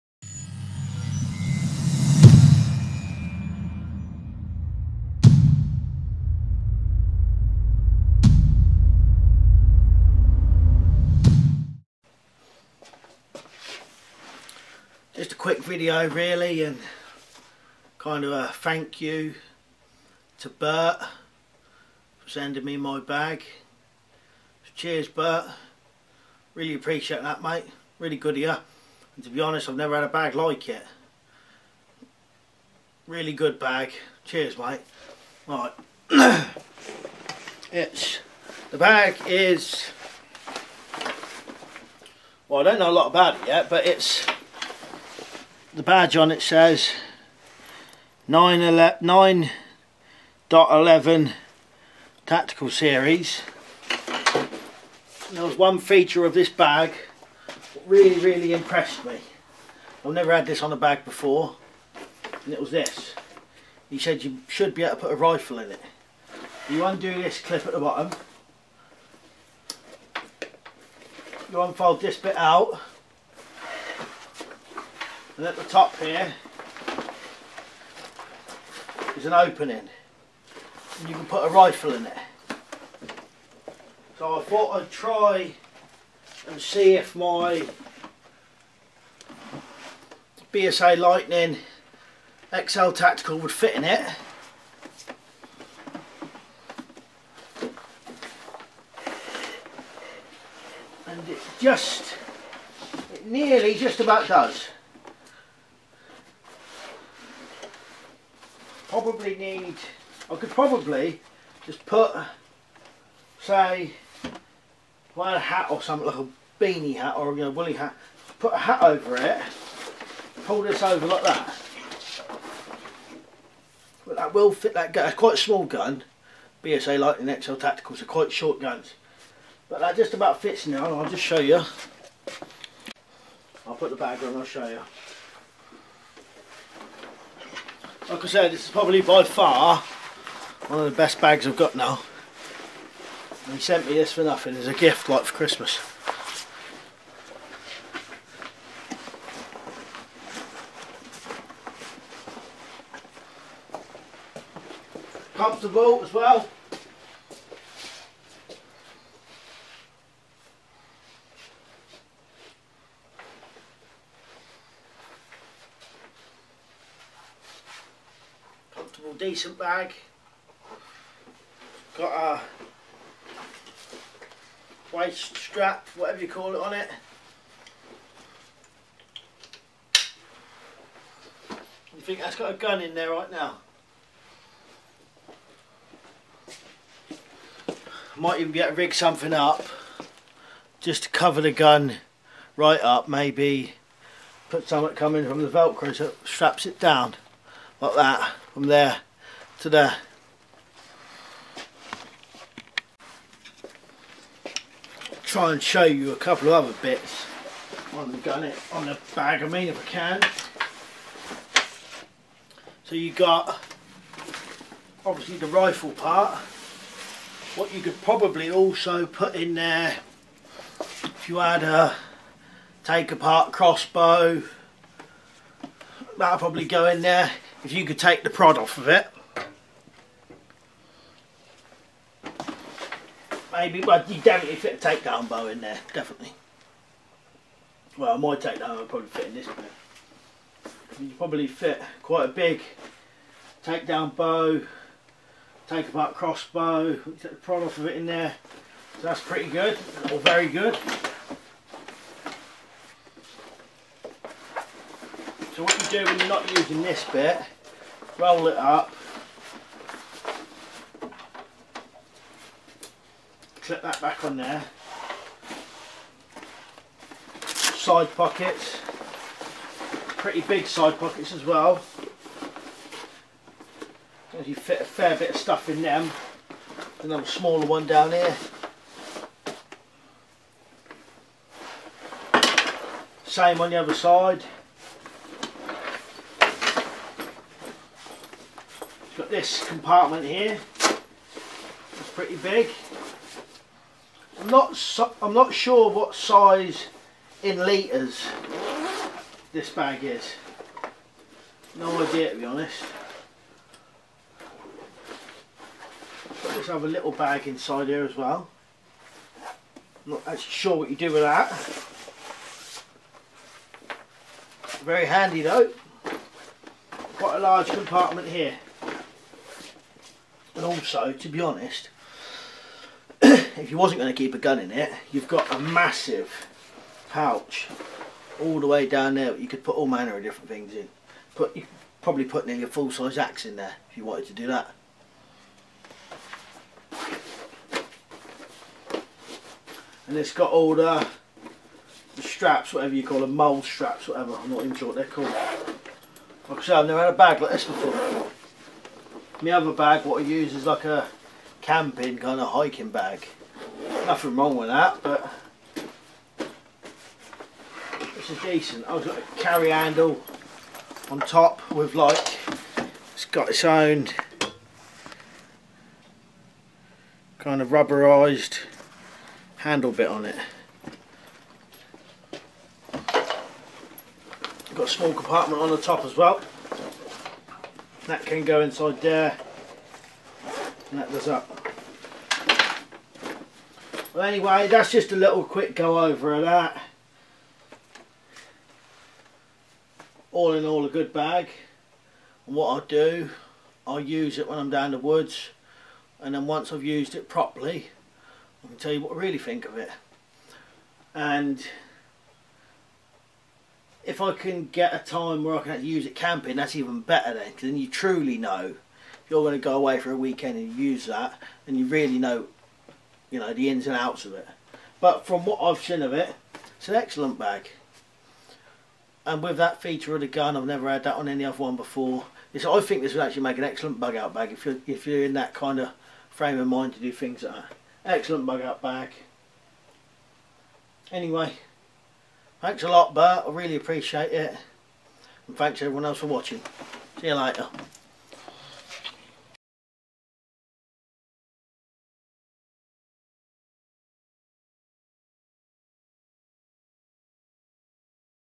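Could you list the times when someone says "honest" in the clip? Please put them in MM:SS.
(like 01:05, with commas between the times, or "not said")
00:29, 05:02, 05:21.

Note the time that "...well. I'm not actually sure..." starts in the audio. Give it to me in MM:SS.
05:08.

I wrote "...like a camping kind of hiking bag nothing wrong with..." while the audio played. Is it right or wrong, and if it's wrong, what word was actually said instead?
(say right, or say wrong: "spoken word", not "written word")
right.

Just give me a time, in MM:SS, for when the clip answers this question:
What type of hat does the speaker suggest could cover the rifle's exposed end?
01:56.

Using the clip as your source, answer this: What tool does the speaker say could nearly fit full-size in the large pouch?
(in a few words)
axe.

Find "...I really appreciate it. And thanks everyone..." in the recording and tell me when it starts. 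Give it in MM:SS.
07:13.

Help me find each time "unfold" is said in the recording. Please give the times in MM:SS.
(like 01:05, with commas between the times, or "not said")
01:11.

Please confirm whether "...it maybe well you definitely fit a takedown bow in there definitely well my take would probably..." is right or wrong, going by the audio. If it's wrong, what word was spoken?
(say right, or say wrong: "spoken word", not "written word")
right.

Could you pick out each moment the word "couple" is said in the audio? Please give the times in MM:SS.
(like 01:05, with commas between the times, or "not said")
03:26.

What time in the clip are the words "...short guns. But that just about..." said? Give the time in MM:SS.
02:08.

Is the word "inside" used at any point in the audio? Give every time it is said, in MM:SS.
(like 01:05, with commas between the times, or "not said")
05:07, 06:18.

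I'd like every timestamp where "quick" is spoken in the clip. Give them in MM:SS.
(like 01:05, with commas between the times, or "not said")
00:15, 06:25.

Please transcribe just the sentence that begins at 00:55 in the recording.
There was one feature of this bag that really, really impressed me.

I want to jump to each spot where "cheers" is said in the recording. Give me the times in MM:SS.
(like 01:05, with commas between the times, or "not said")
00:24, 00:34.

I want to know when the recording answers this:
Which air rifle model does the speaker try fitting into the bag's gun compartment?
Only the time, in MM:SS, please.
01:30.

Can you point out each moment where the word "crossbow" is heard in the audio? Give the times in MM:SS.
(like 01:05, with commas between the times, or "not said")
03:43, 04:06.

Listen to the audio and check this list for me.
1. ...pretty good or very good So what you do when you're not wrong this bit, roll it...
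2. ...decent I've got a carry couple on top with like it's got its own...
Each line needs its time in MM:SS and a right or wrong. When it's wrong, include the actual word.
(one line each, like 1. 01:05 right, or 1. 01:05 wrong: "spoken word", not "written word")
1. 04:09 wrong: "using", not "wrong"
2. 05:58 wrong: "handle", not "couple".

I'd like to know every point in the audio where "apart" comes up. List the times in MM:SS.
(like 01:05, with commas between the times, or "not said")
03:43, 04:05.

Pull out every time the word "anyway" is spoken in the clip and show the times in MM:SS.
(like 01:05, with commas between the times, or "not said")
06:24, 07:11.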